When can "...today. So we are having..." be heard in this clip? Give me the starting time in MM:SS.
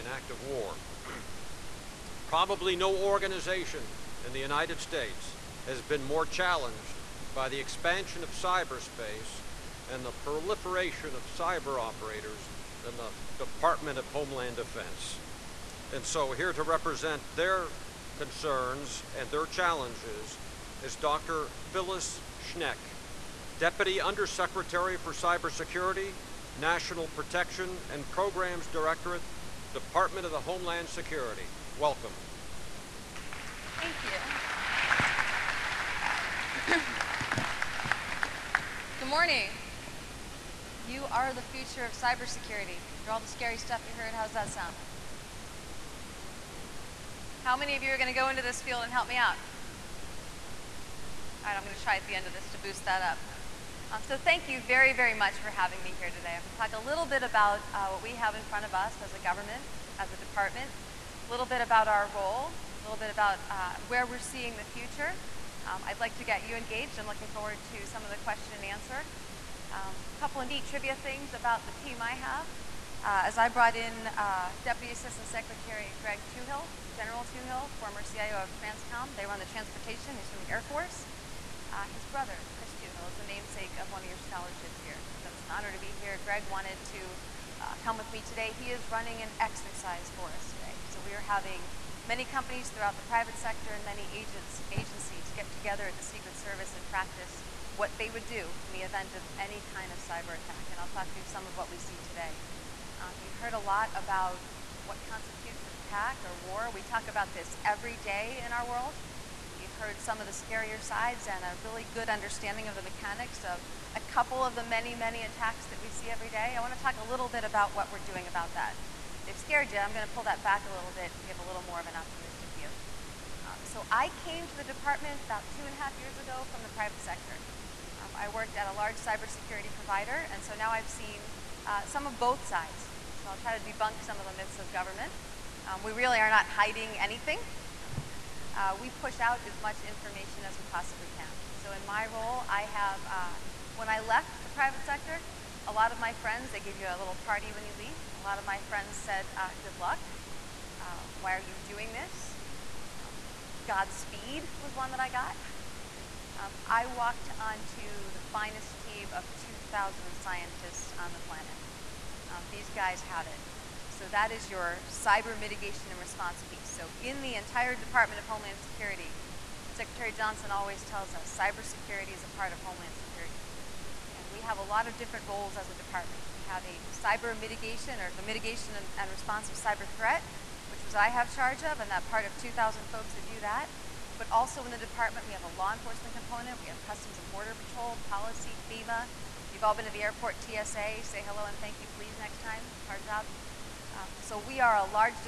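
01:30.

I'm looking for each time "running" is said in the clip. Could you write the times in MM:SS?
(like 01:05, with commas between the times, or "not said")
01:28.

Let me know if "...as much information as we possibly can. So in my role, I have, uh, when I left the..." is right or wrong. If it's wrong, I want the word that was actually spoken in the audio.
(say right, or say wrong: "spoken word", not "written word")
right.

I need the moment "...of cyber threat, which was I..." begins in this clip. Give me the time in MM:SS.
02:59.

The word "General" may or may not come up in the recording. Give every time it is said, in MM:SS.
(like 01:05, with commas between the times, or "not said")
01:16.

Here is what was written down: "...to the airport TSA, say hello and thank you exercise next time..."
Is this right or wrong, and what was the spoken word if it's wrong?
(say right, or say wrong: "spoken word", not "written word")
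wrong: "please", not "exercise".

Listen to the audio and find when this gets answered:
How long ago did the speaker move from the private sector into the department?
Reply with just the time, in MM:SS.
02:05.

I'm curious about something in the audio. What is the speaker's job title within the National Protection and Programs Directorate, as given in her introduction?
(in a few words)
Deputy Undersecretary for Cybersecurity.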